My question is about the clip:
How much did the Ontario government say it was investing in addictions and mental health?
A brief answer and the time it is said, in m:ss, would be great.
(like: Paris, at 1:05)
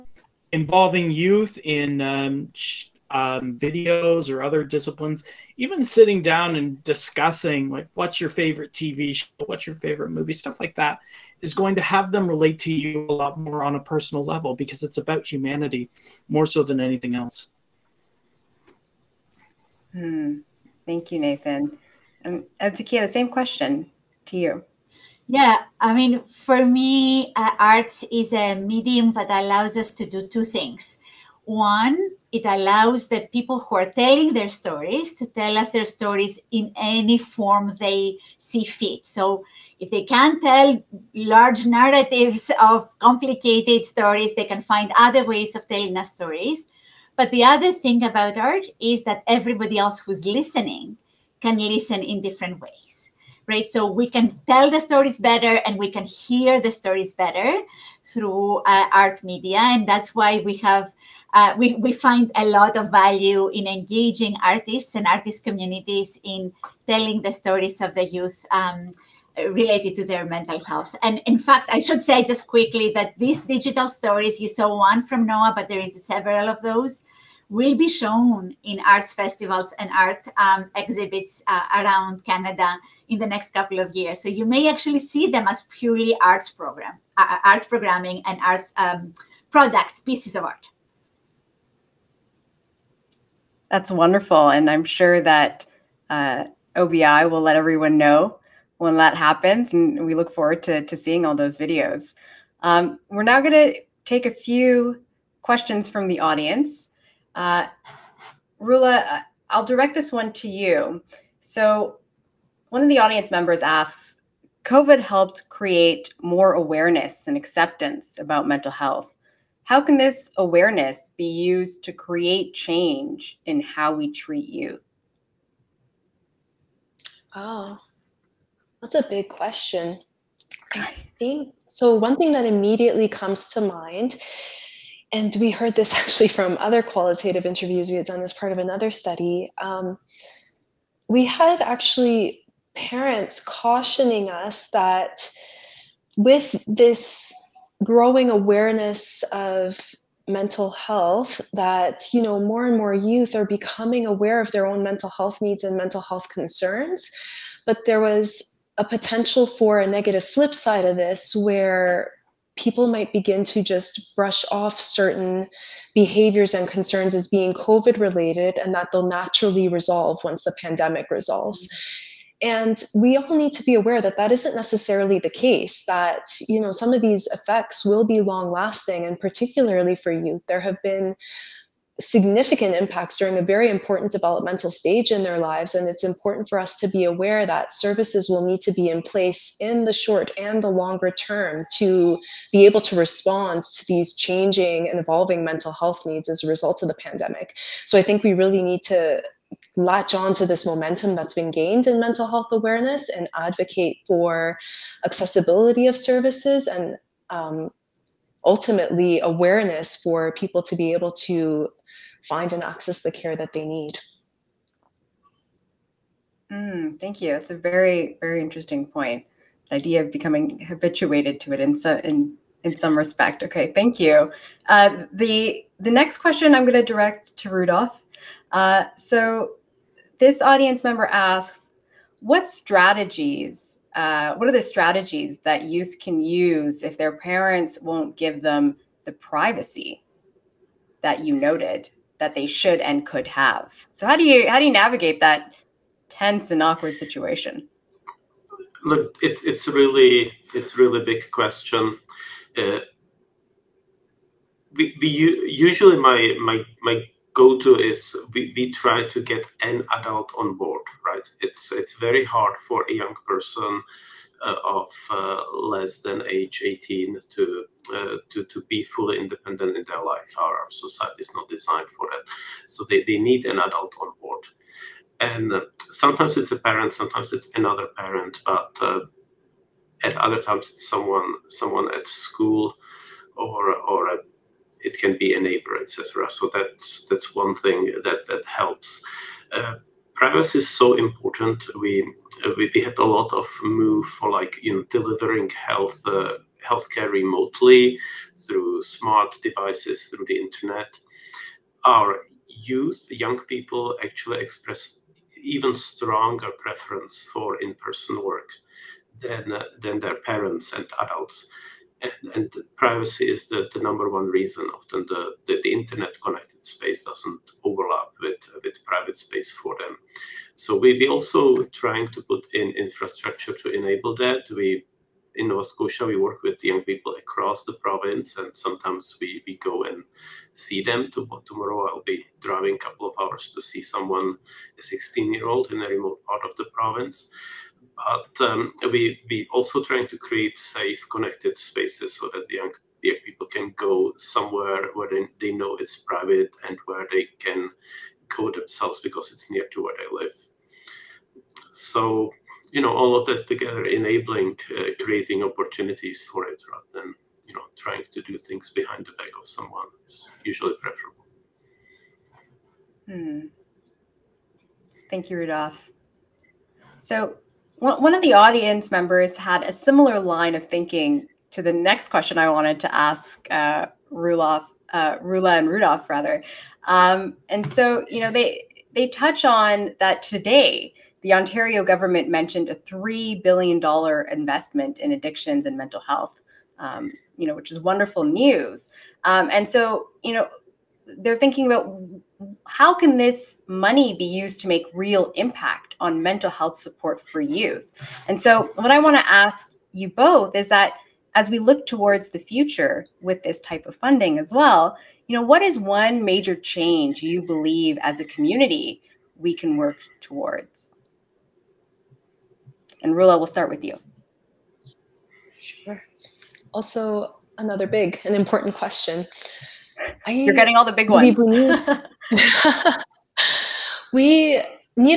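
$3 billion, at 6:22.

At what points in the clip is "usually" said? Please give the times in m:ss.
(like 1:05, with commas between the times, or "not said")
4:15, 6:00.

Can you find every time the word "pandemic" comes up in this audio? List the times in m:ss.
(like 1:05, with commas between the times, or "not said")
2:50, 3:16.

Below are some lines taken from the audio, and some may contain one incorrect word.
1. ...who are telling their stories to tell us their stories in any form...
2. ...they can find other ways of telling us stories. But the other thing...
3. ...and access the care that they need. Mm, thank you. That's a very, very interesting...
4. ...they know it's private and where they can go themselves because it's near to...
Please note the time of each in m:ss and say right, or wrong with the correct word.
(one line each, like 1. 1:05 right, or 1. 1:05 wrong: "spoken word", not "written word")
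1. 0:33 right
2. 0:44 right
3. 3:32 right
4. 5:45 right.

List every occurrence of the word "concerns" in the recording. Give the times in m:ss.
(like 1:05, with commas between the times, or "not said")
2:36, 2:46.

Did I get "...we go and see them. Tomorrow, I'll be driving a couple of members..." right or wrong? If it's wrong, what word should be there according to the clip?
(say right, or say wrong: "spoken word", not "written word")
wrong: "hours", not "members".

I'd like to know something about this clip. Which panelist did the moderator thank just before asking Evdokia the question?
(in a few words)
Nathan.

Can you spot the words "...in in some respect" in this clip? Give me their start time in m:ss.
3:41.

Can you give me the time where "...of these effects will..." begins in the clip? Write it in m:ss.
2:56.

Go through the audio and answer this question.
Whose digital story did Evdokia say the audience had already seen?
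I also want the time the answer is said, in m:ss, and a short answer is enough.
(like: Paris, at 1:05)
Noah, at 1:15.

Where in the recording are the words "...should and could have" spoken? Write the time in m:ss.
4:02.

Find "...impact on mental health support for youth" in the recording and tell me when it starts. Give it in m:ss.
6:35.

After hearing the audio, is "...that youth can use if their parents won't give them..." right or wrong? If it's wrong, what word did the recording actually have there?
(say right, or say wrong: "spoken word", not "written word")
right.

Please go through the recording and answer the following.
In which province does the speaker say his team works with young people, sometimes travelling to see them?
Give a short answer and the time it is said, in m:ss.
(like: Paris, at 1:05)
Nova Scotia, at 5:25.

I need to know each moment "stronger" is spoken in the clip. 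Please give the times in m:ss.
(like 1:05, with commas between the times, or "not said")
5:05.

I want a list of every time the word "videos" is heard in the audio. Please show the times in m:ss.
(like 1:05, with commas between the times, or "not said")
0:03, 1:41.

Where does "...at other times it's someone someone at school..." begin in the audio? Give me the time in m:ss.
4:40.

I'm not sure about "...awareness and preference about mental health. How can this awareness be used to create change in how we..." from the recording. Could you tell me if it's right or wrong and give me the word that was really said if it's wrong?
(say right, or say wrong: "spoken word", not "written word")
wrong: "acceptance", not "preference".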